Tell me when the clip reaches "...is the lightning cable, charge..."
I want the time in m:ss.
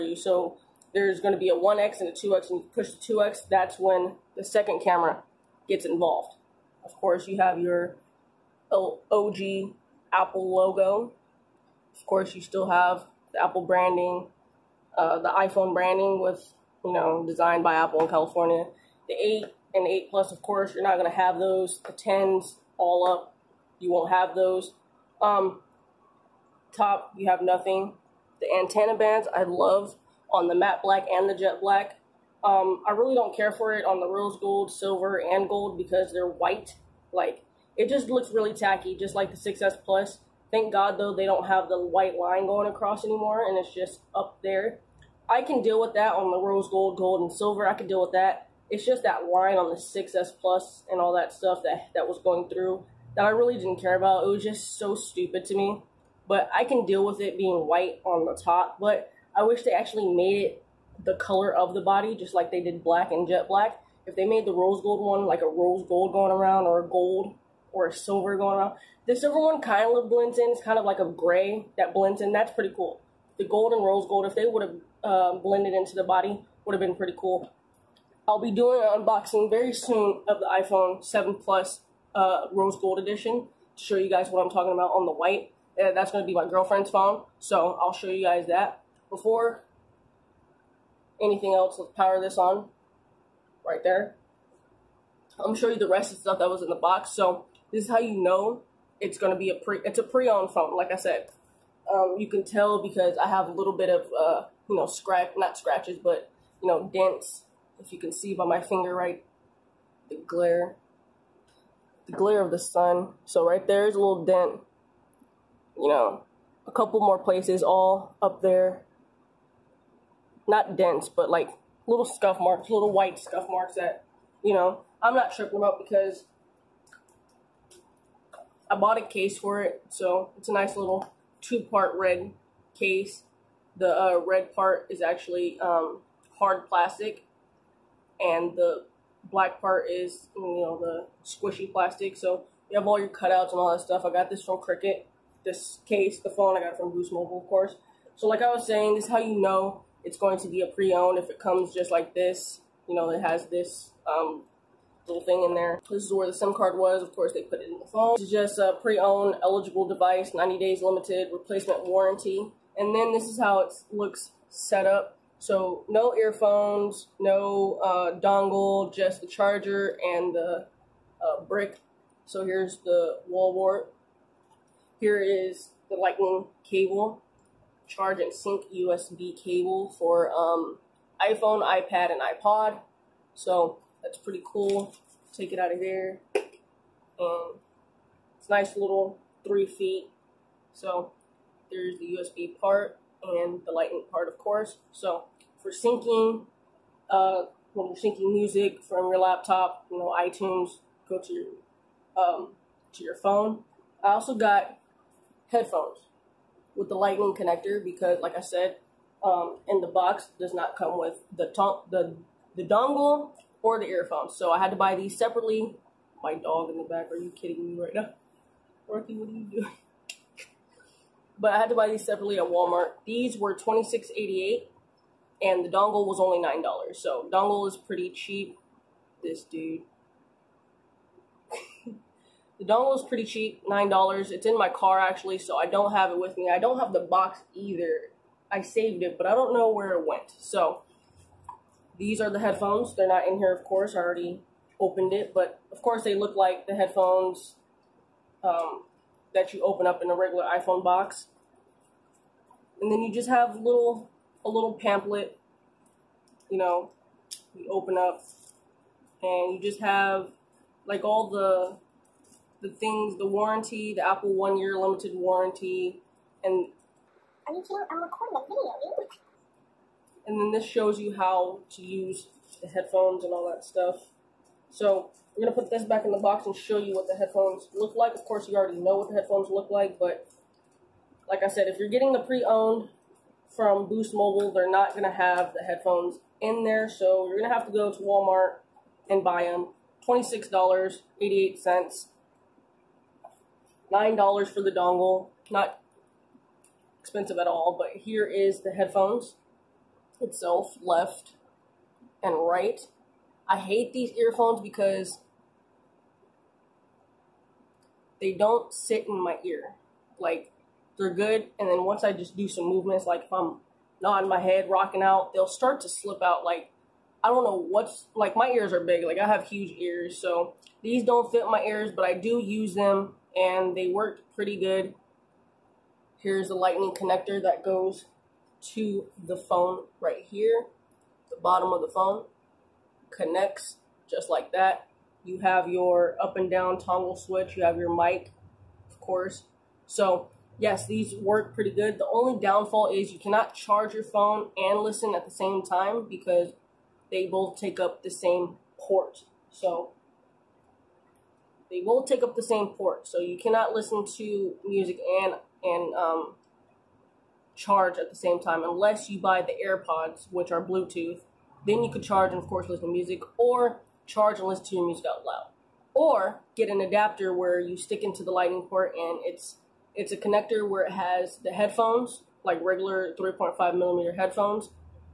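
2:55.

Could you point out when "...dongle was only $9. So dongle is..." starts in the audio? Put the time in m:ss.
3:45.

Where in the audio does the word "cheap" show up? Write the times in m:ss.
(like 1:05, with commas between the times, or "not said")
3:48, 3:53.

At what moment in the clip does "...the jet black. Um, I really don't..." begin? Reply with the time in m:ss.
0:31.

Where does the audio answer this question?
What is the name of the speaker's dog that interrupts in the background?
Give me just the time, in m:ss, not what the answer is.
3:38.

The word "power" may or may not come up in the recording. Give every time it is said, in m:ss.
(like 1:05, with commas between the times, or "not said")
1:31.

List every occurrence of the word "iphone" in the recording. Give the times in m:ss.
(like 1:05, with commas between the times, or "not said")
0:15, 1:20, 3:01, 4:10.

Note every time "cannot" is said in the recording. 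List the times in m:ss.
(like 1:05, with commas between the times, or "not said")
5:43, 5:53.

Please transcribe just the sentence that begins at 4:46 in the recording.
So you're going to have to go to Walmart and buy them.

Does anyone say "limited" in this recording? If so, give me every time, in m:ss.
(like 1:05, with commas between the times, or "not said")
2:40, 4:24.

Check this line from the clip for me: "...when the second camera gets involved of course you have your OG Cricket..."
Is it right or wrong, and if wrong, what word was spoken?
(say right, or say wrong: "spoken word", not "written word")
wrong: "Apple", not "Cricket".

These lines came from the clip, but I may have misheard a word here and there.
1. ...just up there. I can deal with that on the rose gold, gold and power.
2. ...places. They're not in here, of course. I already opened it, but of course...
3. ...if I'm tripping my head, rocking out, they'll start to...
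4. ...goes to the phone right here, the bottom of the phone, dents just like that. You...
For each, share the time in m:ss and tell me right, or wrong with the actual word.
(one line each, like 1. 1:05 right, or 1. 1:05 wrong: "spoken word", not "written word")
1. 0:43 wrong: "silver", not "power"
2. 4:02 wrong: "headphones", not "places"
3. 5:13 wrong: "nodding", not "tripping"
4. 5:27 wrong: "connects", not "dents".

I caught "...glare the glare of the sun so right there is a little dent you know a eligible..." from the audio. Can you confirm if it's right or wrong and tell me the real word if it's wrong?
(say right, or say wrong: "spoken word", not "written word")
wrong: "couple", not "eligible".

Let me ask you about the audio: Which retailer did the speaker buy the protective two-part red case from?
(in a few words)
Cricket.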